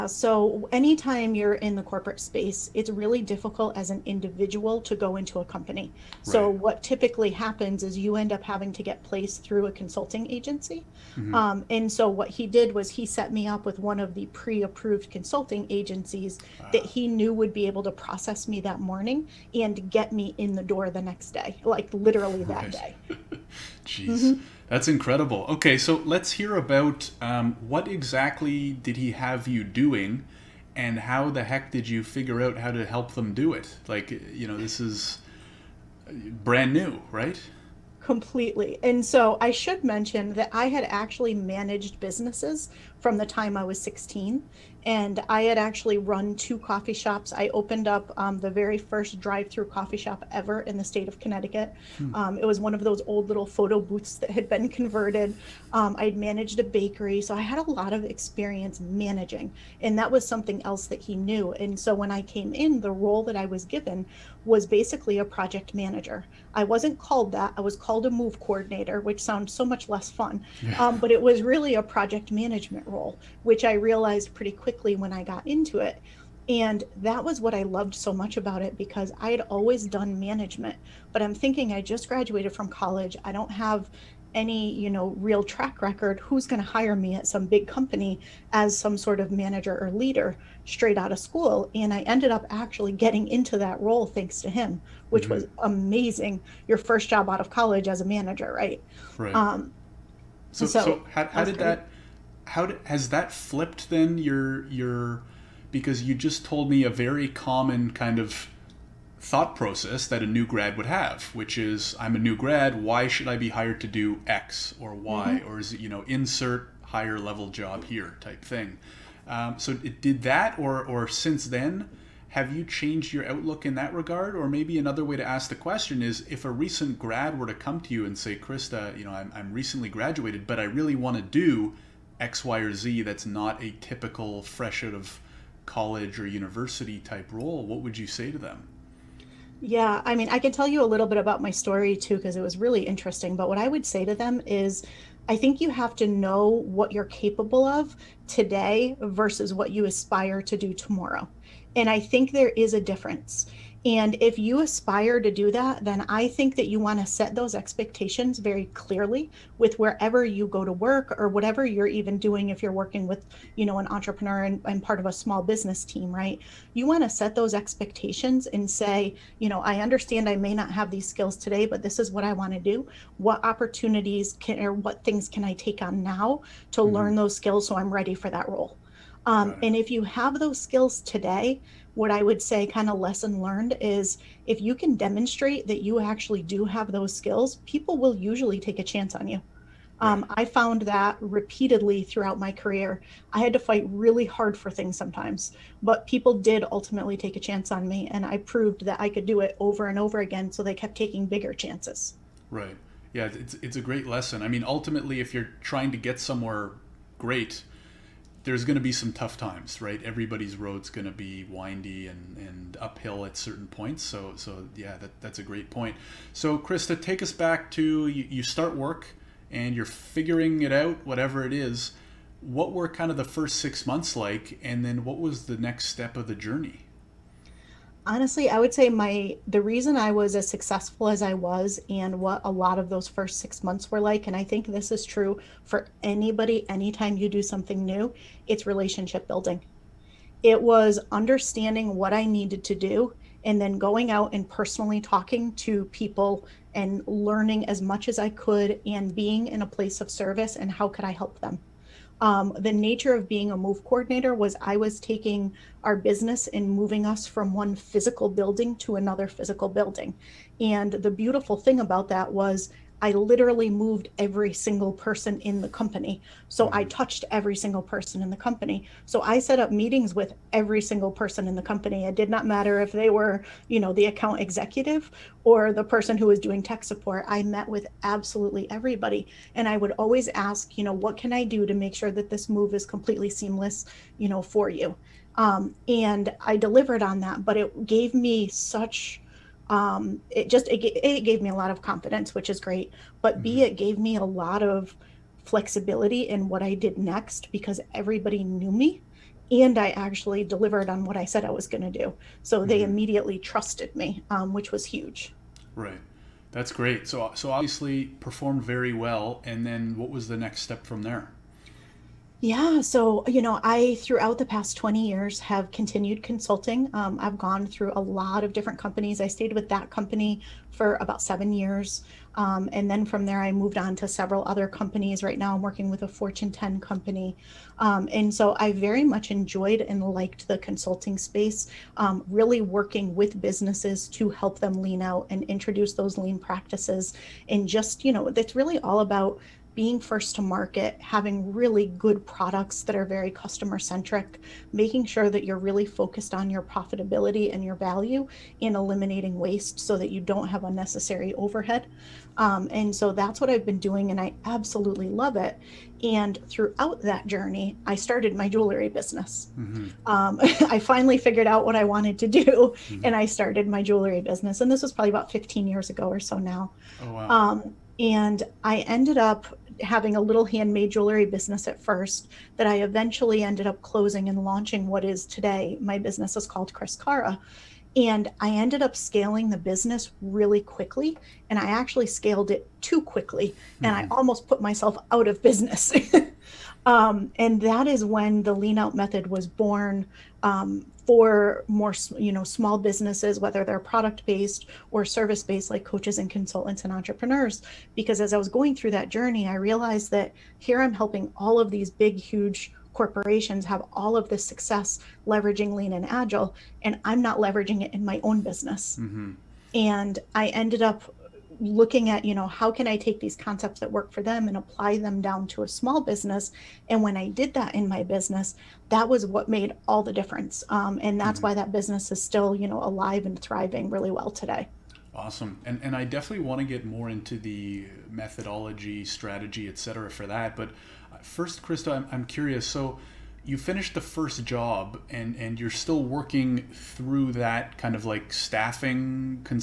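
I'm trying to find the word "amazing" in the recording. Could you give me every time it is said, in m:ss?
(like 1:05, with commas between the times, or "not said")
1:35.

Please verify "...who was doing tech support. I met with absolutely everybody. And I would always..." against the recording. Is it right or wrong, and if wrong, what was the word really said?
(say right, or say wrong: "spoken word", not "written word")
right.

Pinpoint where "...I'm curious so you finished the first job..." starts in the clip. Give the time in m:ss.
7:12.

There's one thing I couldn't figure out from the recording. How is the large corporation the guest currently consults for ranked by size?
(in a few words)
Fortune 10.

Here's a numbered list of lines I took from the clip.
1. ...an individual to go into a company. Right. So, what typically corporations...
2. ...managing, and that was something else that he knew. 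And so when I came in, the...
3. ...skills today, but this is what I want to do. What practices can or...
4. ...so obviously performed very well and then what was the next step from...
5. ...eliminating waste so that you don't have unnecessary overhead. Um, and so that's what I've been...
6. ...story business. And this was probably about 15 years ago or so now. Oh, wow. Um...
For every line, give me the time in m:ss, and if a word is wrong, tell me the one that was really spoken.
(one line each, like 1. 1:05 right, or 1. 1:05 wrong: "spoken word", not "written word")
1. 0:03 wrong: "happens", not "corporations"
2. 0:58 right
3. 2:51 wrong: "opportunities", not "practices"
4. 5:07 right
5. 5:48 right
6. 6:03 wrong: "jewelry", not "story".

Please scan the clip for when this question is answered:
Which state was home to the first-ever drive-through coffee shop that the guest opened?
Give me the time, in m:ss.
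0:51.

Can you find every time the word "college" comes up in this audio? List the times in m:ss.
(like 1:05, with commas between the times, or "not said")
1:22, 1:37, 2:15.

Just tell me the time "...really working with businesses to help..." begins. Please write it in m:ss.
5:32.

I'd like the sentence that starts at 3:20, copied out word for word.
So they kept taking bigger chances.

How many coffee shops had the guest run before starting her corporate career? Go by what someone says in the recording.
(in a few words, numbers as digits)
2.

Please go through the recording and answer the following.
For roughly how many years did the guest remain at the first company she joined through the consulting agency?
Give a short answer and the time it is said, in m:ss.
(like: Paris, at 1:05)
7, at 5:21.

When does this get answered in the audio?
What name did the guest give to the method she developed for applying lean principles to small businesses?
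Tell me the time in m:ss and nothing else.
6:28.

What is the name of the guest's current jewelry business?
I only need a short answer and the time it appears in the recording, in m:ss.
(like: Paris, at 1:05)
Chris Cara, at 6:16.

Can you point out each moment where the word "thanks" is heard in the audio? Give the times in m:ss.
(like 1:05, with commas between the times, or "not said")
1:34.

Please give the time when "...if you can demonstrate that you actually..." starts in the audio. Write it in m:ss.
3:04.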